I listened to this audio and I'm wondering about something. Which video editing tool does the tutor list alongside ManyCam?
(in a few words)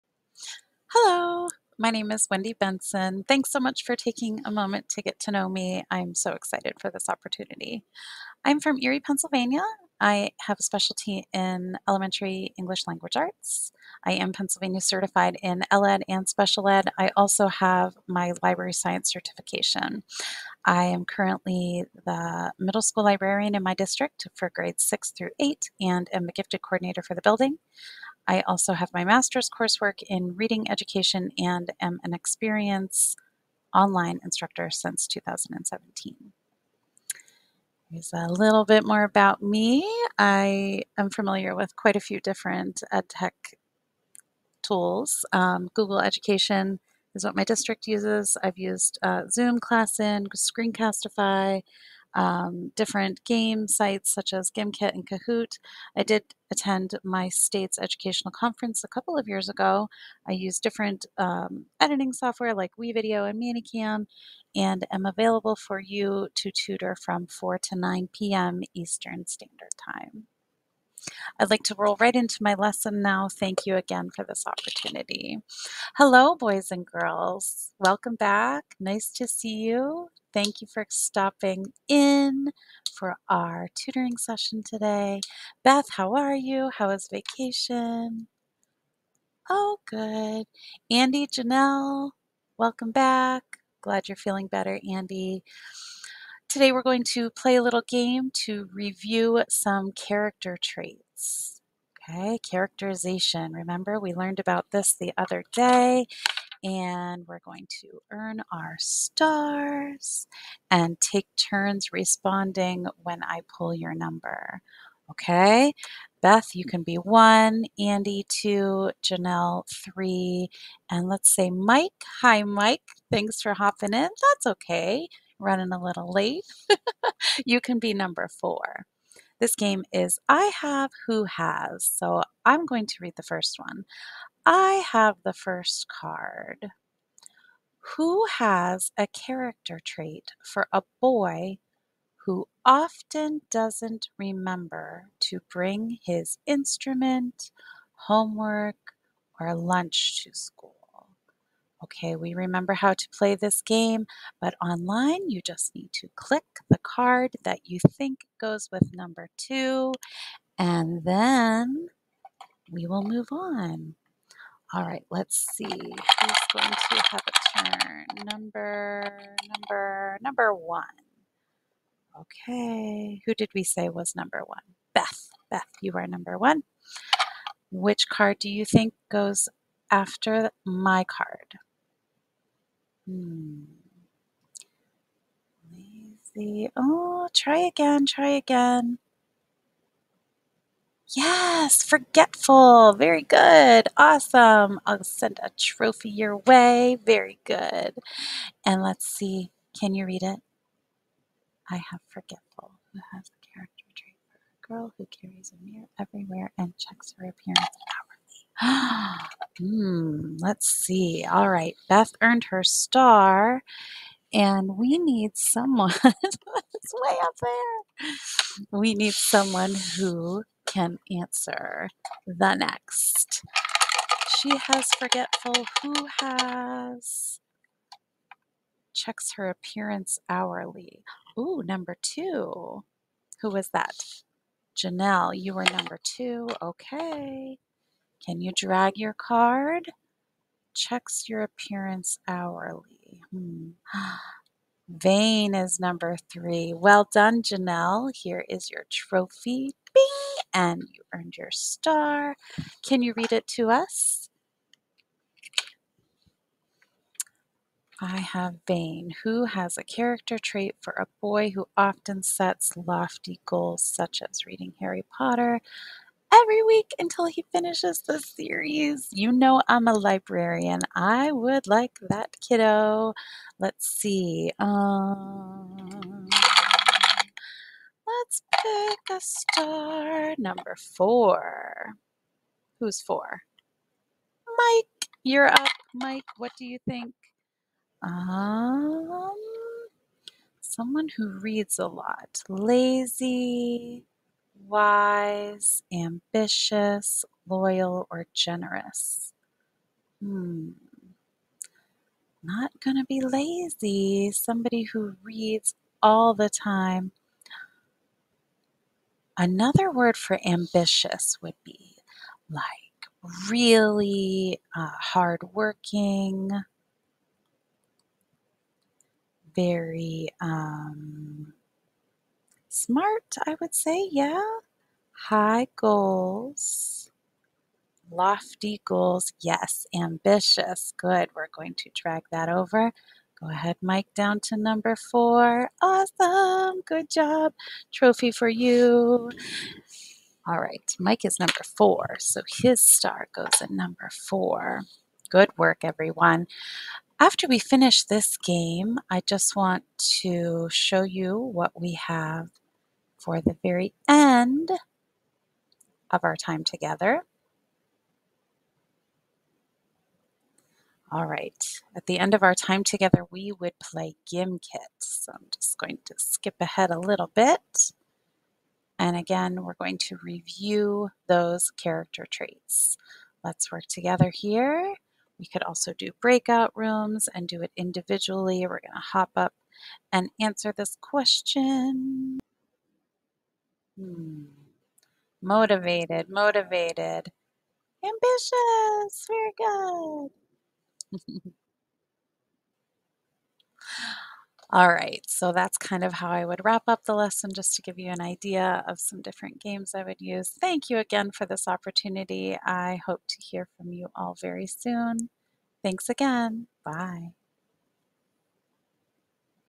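WeVideo.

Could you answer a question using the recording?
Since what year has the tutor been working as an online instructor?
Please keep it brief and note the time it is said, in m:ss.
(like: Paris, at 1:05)
2017, at 0:35.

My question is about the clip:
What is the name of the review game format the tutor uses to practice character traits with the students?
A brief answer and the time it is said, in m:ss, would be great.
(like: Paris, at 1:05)
I have, who has, at 2:10.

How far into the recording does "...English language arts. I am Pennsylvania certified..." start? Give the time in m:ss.
0:12.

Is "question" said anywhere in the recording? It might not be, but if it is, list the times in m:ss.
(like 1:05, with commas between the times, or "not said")
6:21.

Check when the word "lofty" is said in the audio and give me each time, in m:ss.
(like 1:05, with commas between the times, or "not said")
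4:22, 5:28.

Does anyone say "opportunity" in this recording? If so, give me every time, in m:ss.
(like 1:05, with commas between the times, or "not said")
0:07, 1:14, 6:41.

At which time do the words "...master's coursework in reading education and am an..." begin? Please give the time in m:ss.
0:29.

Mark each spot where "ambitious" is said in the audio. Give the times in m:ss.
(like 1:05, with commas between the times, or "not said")
4:55, 5:10, 5:29, 6:28.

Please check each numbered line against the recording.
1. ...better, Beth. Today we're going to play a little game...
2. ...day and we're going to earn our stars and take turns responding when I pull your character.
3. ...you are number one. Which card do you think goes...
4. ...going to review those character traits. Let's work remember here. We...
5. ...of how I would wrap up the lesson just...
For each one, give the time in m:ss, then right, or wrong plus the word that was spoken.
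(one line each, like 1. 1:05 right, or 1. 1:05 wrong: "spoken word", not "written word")
1. 1:34 wrong: "Andy", not "Beth"
2. 1:45 wrong: "number", not "character"
3. 2:55 right
4. 6:09 wrong: "together", not "remember"
5. 6:36 right.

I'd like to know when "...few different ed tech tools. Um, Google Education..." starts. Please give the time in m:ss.
0:41.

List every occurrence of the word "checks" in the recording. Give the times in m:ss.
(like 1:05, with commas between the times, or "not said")
3:26, 3:48, 4:00.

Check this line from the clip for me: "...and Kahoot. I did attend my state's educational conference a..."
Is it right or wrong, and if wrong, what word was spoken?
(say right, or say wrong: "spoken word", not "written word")
right.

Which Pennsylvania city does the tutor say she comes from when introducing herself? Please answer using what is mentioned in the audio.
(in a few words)
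Erie.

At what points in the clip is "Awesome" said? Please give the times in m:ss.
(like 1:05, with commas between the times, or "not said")
3:13, 5:35.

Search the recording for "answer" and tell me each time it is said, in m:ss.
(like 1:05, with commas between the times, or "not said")
3:41, 6:20.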